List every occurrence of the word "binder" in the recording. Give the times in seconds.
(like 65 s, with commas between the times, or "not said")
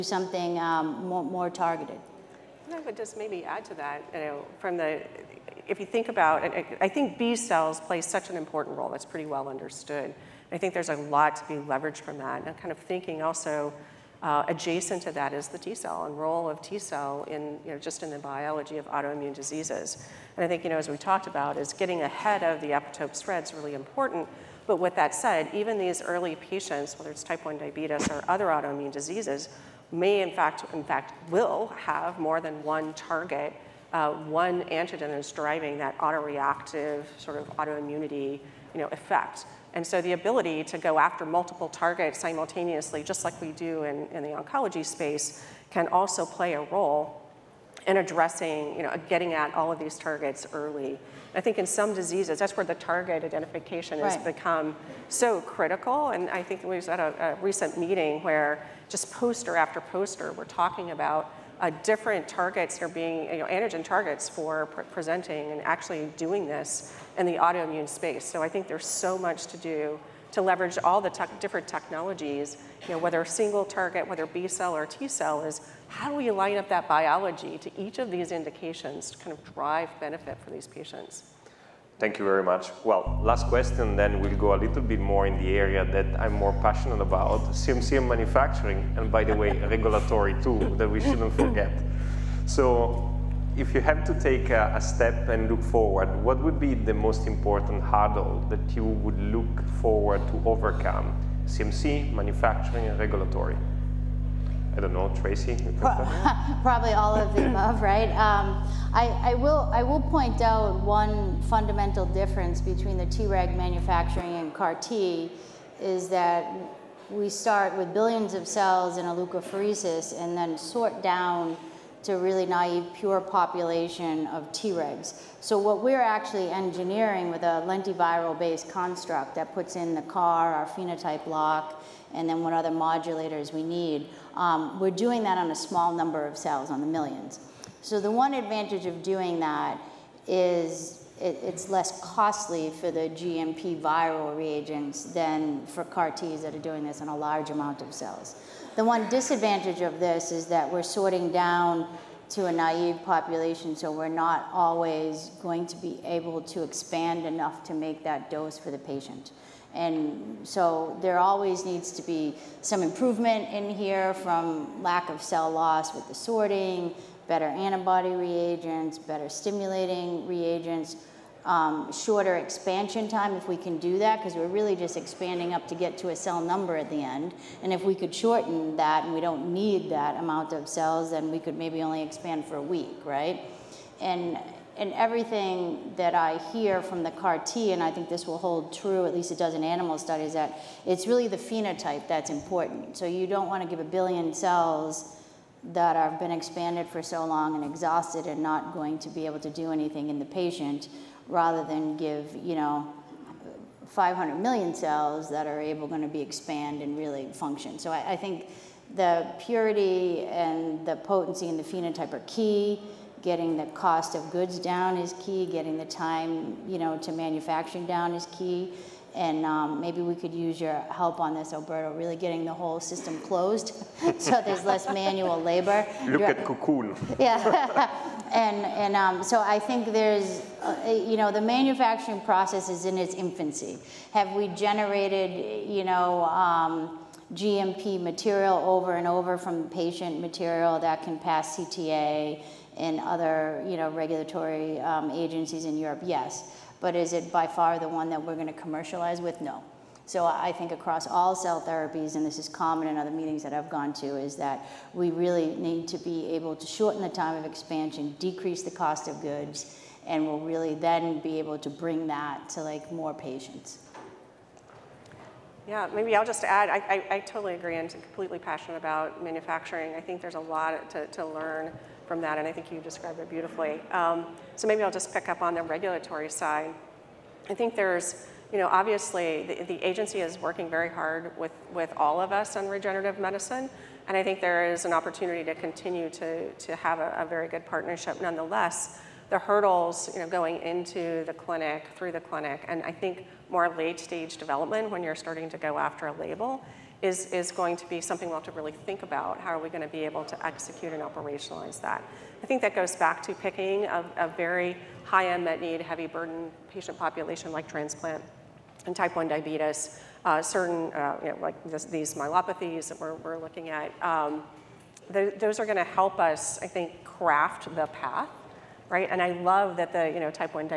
not said.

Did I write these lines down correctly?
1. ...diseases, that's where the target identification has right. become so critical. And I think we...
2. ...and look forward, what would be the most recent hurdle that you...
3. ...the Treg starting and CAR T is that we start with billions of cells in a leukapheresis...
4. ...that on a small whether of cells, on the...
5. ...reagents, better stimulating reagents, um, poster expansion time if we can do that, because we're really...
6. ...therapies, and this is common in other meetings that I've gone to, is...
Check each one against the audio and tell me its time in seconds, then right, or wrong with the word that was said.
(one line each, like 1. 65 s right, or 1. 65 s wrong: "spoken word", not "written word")
1. 51 s right
2. 95 s wrong: "important", not "recent"
3. 112 s wrong: "manufacturing", not "starting"
4. 135 s wrong: "number", not "whether"
5. 168 s wrong: "shorter", not "poster"
6. 251 s right.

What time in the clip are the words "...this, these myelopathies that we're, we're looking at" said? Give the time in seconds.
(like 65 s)
311 s.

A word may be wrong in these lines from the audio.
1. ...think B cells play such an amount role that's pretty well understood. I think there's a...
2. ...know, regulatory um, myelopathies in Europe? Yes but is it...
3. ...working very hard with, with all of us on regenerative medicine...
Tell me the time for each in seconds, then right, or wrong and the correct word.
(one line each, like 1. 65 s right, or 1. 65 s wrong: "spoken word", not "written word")
1. 6 s wrong: "important", not "amount"
2. 243 s wrong: "agencies", not "myelopathies"
3. 280 s right.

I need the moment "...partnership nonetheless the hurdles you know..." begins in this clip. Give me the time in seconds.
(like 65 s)
287 s.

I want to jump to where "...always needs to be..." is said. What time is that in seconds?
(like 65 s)
161 s.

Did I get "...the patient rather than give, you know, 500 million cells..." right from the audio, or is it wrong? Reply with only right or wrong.
right.